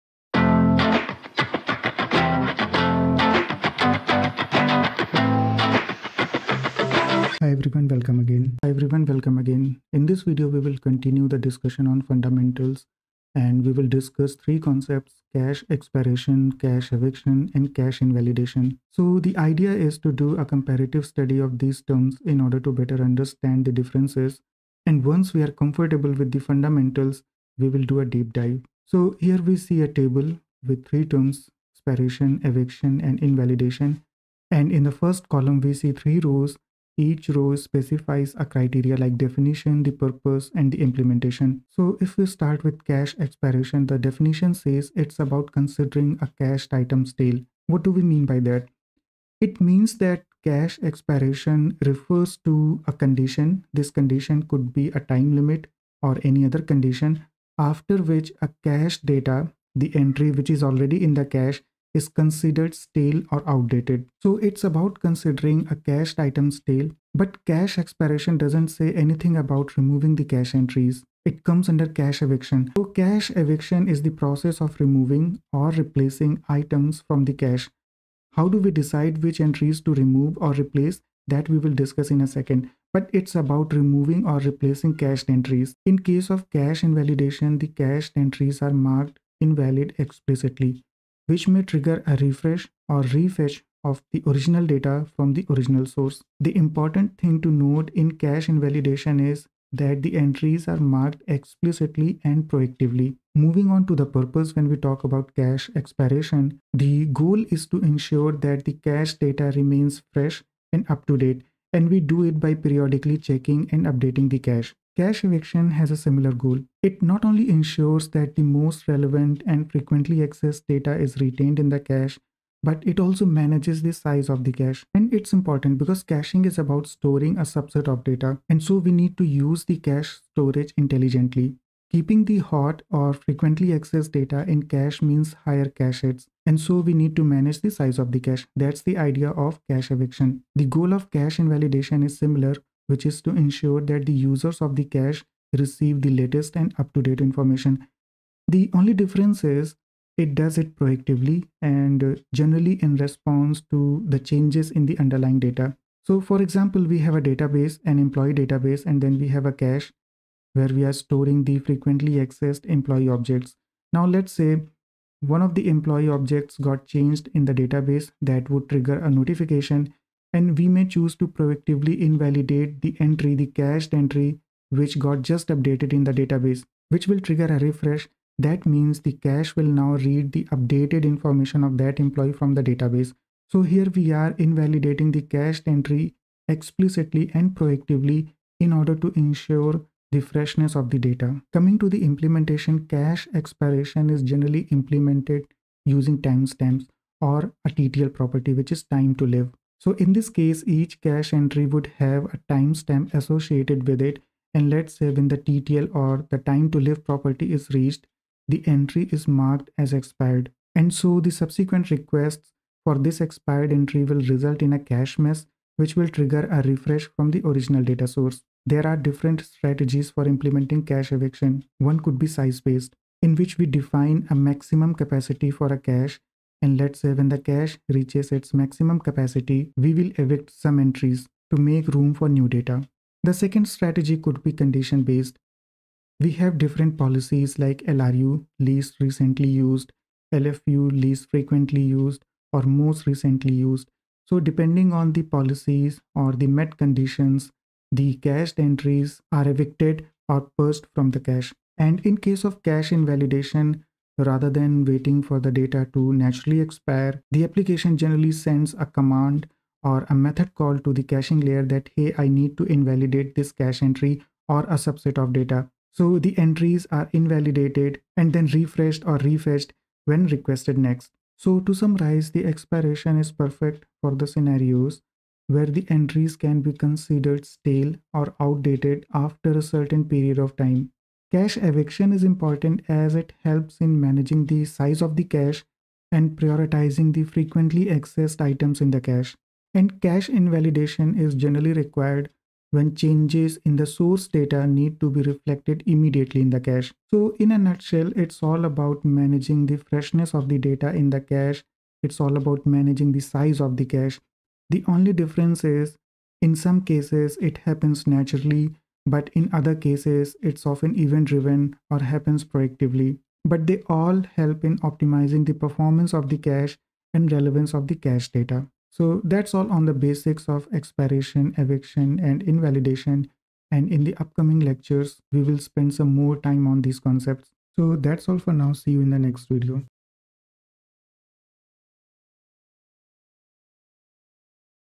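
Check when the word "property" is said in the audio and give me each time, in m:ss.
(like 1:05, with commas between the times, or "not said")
3:18, 3:27.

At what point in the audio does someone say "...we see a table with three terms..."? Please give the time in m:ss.
0:29.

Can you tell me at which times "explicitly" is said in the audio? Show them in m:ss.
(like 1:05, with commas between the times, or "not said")
1:29, 1:41, 3:06.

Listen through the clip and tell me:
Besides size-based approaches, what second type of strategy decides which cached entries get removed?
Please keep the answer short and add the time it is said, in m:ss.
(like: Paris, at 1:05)
condition based, at 3:54.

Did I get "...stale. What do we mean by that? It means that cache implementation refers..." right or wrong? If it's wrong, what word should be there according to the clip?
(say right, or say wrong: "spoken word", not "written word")
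wrong: "expiration", not "implementation".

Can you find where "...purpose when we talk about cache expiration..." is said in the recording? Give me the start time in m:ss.
1:44.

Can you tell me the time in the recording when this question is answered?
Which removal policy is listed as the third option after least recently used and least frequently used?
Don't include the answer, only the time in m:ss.
4:02.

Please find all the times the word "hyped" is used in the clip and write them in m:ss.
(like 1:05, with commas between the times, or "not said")
not said.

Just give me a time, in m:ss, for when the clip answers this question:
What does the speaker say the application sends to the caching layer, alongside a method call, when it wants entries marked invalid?
4:18.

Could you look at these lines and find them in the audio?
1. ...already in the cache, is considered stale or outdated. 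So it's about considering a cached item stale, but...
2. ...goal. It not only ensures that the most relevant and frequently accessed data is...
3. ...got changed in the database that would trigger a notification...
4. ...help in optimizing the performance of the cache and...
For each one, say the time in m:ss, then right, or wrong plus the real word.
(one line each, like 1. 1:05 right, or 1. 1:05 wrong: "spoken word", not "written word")
1. 1:00 right
2. 1:56 right
3. 2:46 right
4. 5:14 right.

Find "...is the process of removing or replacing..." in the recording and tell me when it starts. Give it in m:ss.
1:13.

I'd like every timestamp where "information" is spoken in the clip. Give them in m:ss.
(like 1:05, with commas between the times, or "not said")
2:27, 3:01.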